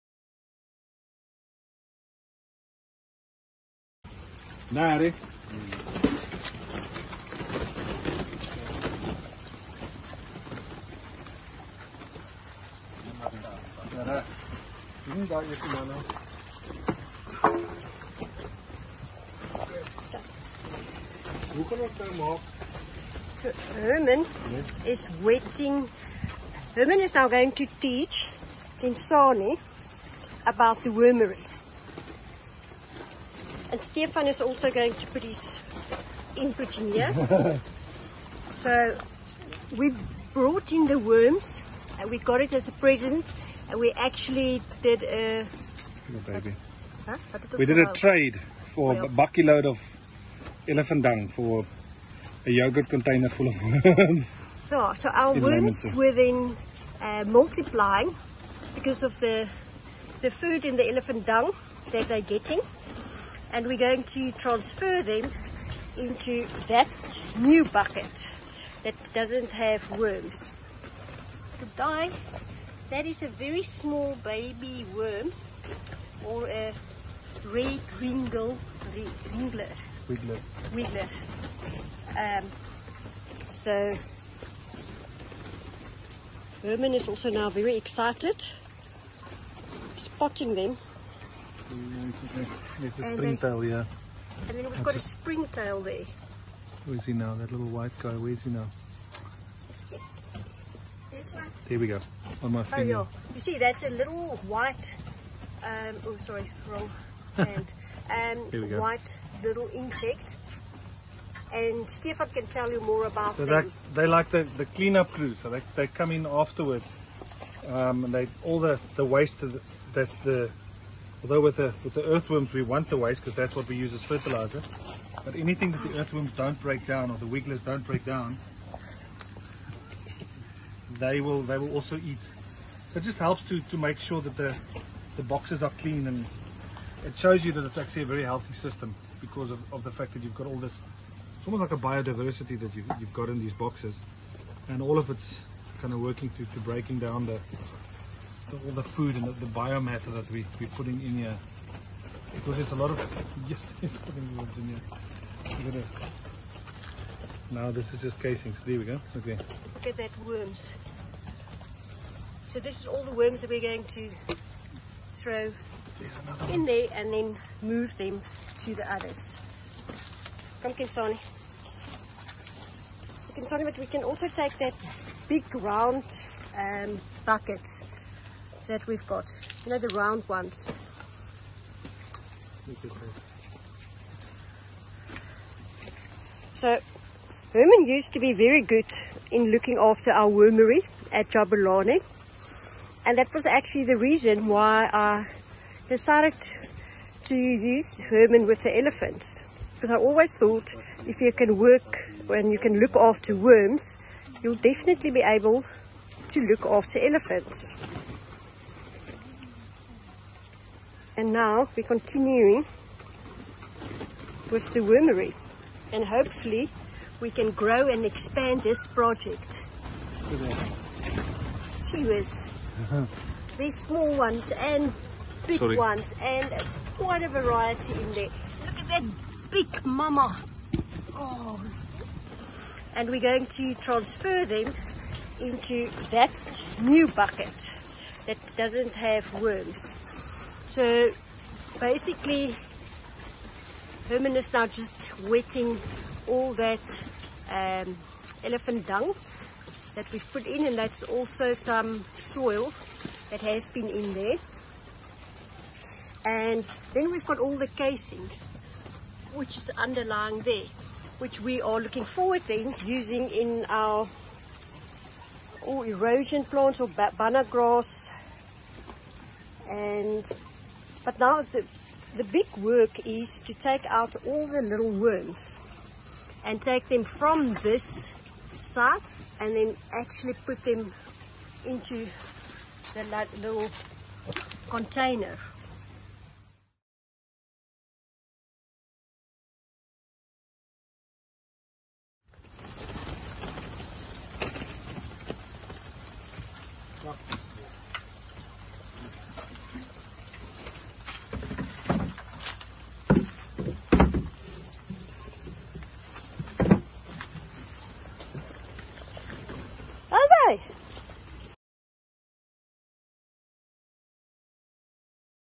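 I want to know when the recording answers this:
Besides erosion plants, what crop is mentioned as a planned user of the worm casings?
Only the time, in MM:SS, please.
04:26.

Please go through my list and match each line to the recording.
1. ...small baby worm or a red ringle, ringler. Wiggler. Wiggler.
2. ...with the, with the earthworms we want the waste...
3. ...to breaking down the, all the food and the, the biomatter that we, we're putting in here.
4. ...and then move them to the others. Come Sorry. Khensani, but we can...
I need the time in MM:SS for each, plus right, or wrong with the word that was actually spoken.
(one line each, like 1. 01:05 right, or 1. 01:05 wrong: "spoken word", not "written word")
1. 01:13 right
2. 02:01 right
3. 02:26 right
4. 02:46 wrong: "Khensani", not "Sorry".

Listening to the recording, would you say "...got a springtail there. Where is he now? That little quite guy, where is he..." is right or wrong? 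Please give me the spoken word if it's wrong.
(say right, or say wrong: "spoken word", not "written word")
wrong: "white", not "quite".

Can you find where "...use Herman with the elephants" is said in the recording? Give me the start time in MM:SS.
03:17.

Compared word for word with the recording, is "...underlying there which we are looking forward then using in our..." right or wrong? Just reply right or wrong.
right.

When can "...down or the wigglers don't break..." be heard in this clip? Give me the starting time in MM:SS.
02:06.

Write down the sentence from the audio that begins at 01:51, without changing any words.
And Stefan can tell you more about so them.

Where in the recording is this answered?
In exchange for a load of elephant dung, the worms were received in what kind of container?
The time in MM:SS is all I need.
00:52.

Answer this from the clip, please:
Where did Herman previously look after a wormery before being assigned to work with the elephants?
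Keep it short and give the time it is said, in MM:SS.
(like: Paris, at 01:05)
Jabulani, at 03:11.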